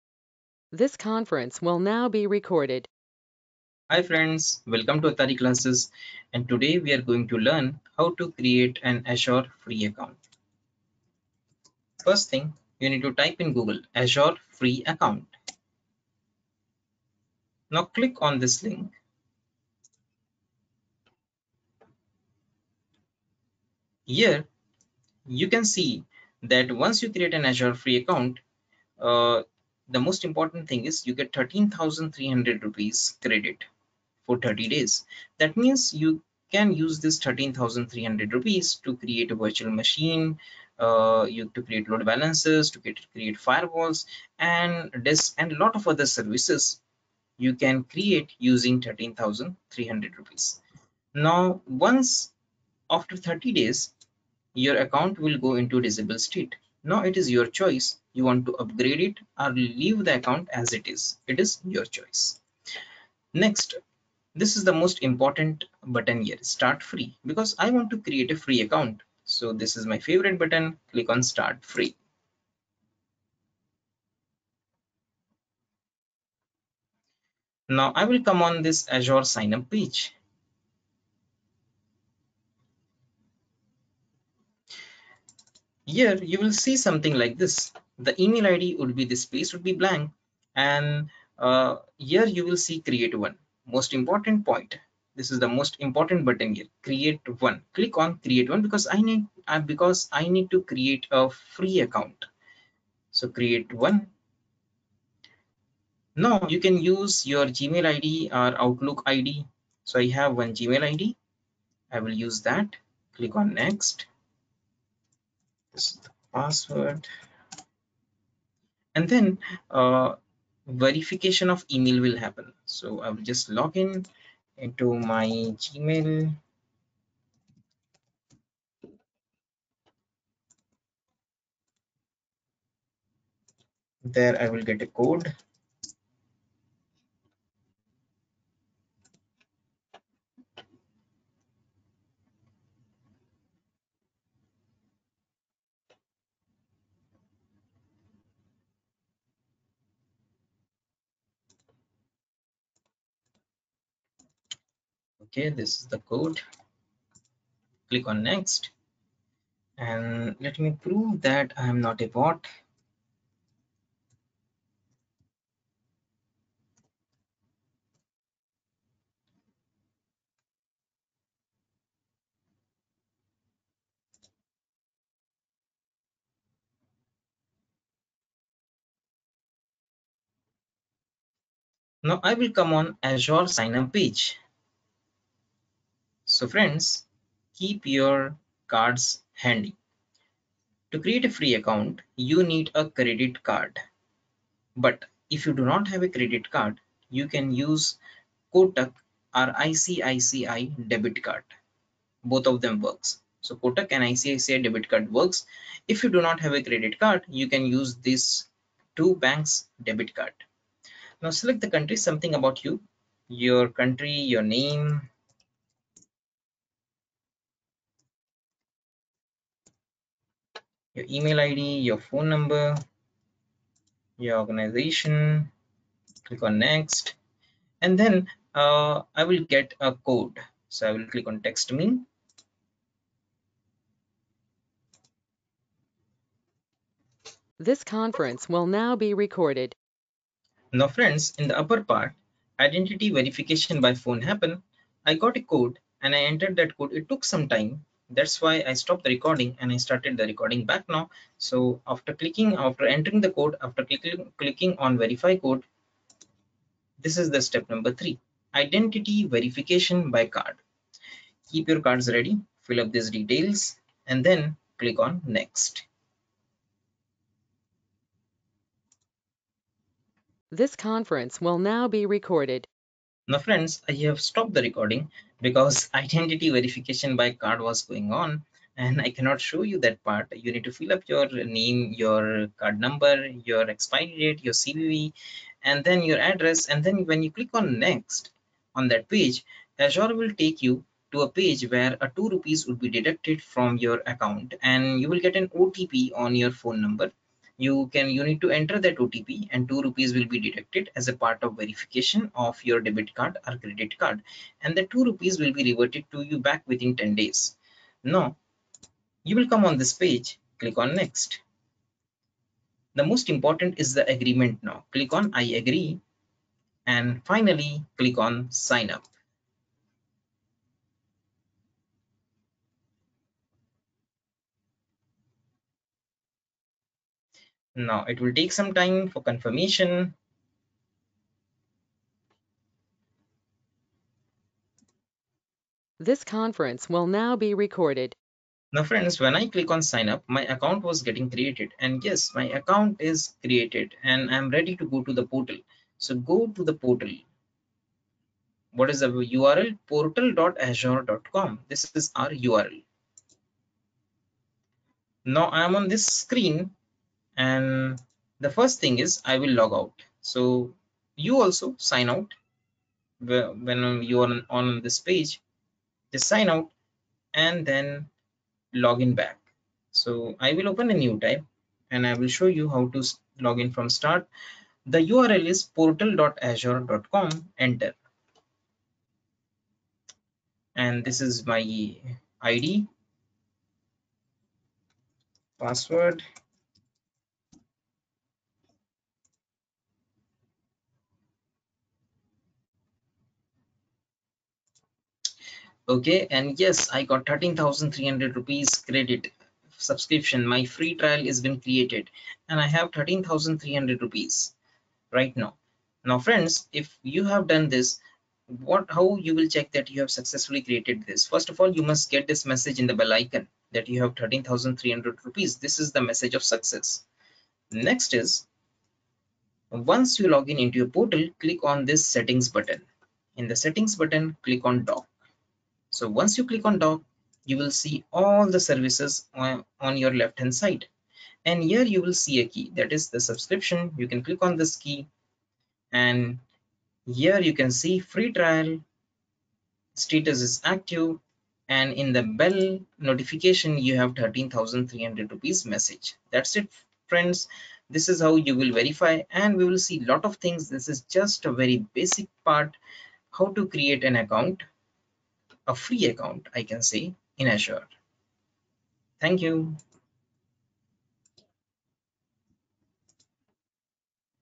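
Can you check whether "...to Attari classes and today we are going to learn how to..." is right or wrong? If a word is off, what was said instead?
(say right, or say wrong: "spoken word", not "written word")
right.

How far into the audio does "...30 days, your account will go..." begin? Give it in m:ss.
0:53.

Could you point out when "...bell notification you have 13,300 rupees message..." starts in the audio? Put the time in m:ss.
7:22.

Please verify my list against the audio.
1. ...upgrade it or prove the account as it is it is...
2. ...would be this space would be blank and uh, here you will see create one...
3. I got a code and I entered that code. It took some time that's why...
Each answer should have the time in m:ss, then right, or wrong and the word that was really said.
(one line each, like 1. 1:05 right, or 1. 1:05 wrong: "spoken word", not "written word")
1. 0:58 wrong: "leave", not "prove"
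2. 1:28 right
3. 4:05 right.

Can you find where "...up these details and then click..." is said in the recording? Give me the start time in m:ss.
4:22.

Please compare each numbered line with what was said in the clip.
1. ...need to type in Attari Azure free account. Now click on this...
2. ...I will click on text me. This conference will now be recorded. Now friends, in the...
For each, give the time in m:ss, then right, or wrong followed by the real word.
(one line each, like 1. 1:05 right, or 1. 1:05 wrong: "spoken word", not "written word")
1. 0:12 wrong: "Google", not "Attari"
2. 3:50 right.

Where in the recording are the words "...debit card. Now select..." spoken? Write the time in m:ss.
3:29.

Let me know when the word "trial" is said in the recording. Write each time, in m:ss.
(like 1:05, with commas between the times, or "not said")
6:40, 7:18.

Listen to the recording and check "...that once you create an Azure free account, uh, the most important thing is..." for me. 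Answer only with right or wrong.
right.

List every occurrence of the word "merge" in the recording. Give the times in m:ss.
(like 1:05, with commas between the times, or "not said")
not said.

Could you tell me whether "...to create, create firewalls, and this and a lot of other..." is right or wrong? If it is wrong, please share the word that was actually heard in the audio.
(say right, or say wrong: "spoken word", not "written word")
right.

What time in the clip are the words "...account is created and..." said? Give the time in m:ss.
5:42.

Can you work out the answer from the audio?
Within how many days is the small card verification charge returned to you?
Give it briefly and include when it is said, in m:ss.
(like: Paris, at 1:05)
10 days, at 5:07.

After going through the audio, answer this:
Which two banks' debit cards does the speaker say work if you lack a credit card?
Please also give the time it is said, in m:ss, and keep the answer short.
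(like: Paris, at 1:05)
Kotak and ICICI, at 3:23.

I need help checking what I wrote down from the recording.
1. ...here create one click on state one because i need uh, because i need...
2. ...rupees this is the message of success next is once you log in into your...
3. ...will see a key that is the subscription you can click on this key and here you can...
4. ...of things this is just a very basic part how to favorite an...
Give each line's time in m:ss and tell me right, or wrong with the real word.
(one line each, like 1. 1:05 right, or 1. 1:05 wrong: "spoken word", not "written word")
1. 1:36 wrong: "create", not "state"
2. 6:55 right
3. 7:12 right
4. 7:30 wrong: "create", not "favorite".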